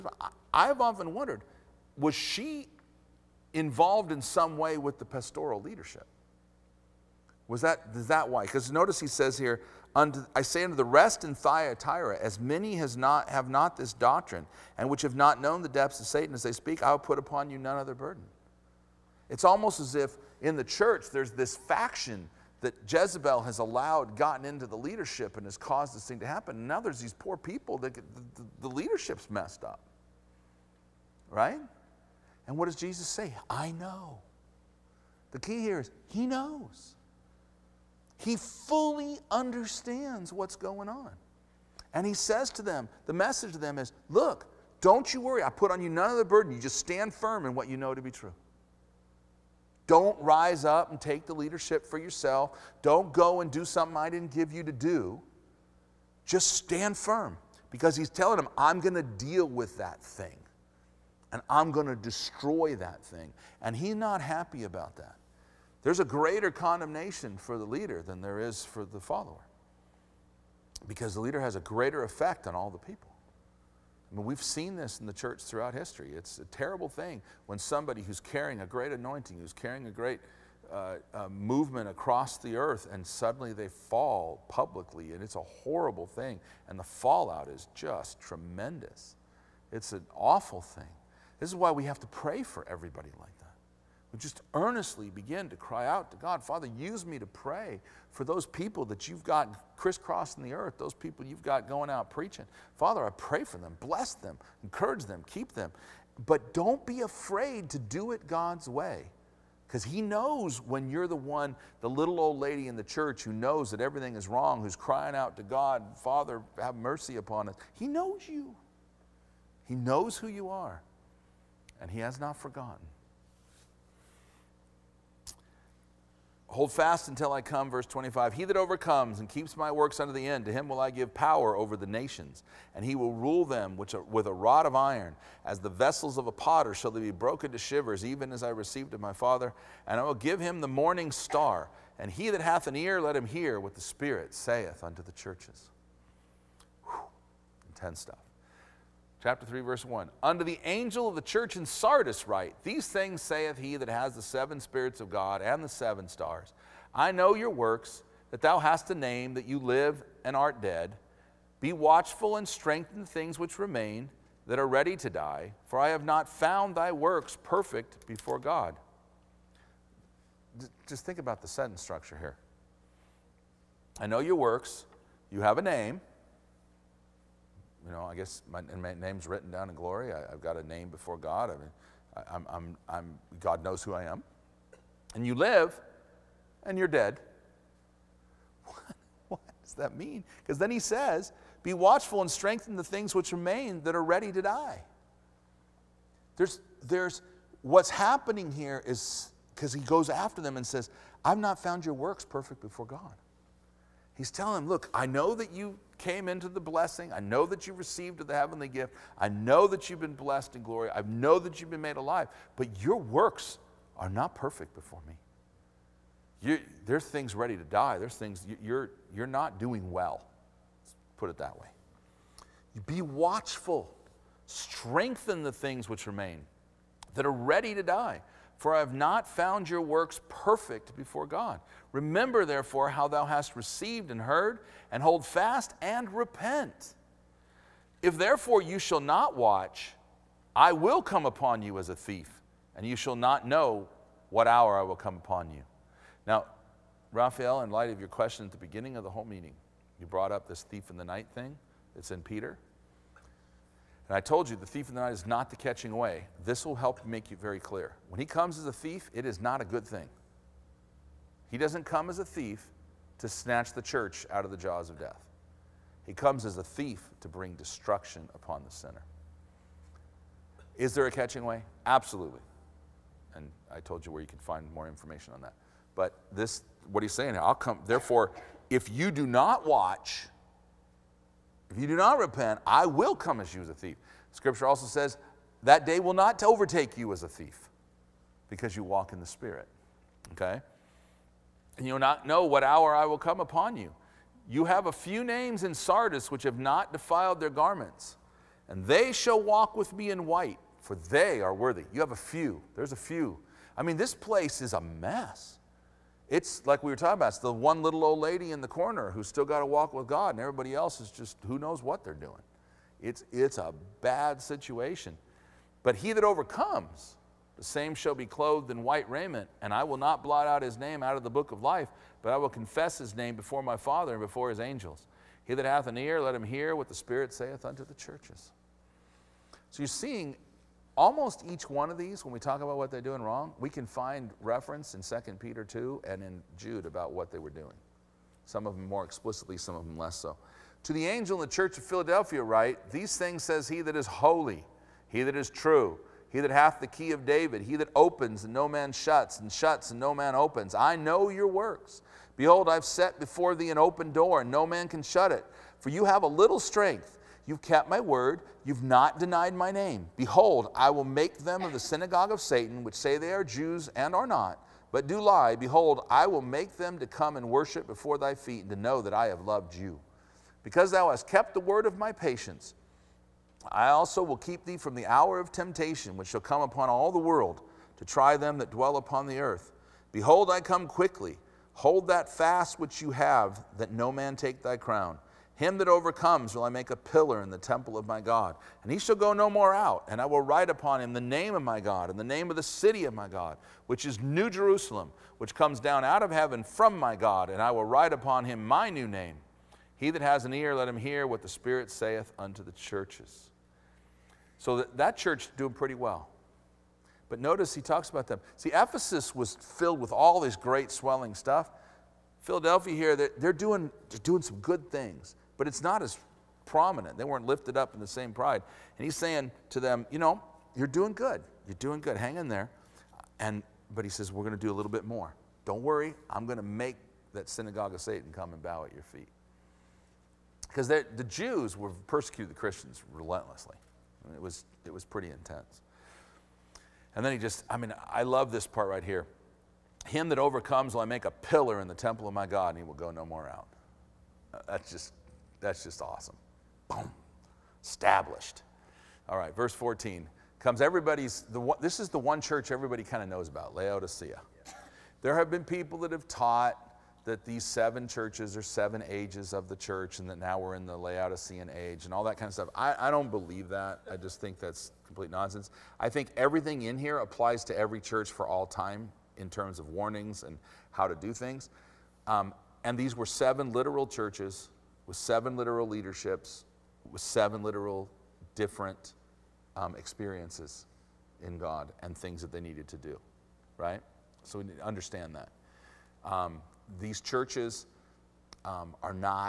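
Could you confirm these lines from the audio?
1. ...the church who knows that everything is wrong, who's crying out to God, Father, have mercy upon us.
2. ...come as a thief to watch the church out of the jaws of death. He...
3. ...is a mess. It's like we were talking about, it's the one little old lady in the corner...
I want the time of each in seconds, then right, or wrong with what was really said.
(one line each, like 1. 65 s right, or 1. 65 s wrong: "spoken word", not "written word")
1. 112 s right
2. 261 s wrong: "snatch", not "watch"
3. 304 s right.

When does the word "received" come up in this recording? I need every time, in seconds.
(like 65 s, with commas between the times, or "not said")
138 s, 207 s, 233 s.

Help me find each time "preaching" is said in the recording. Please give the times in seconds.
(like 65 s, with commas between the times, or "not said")
102 s.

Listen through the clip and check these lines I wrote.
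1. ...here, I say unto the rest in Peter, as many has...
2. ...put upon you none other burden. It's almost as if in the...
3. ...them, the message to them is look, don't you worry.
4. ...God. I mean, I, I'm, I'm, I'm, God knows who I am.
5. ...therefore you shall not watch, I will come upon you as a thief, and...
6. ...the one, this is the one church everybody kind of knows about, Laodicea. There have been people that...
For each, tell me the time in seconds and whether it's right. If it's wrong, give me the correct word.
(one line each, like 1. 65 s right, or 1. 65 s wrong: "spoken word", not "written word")
1. 9 s wrong: "Thyatira", not "Peter"
2. 16 s right
3. 42 s right
4. 181 s right
5. 238 s right
6. 451 s right.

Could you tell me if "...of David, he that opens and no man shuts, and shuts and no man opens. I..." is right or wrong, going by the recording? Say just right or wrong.
right.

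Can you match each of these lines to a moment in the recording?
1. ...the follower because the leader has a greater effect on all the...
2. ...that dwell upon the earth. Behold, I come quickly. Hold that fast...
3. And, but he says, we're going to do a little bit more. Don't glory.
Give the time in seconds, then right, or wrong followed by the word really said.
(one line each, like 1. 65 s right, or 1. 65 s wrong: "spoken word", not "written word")
1. 68 s right
2. 378 s right
3. 423 s wrong: "worry", not "glory".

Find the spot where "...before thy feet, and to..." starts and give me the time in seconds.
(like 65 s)
367 s.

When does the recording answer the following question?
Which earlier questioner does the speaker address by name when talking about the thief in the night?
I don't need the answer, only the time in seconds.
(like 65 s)
247 s.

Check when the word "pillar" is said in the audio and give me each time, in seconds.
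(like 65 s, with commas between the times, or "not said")
386 s, 441 s.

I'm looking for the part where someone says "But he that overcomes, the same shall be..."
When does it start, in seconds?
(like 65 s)
315 s.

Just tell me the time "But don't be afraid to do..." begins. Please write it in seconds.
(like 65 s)
106 s.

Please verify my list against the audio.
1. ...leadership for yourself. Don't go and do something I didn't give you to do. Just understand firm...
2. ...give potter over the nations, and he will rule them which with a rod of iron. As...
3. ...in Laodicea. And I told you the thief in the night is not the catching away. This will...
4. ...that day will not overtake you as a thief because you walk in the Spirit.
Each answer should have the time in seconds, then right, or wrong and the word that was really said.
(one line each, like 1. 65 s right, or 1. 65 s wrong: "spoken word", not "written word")
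1. 51 s wrong: "stand", not "understand"
2. 130 s wrong: "power", not "potter"
3. 252 s wrong: "Peter", not "Laodicea"
4. 285 s right.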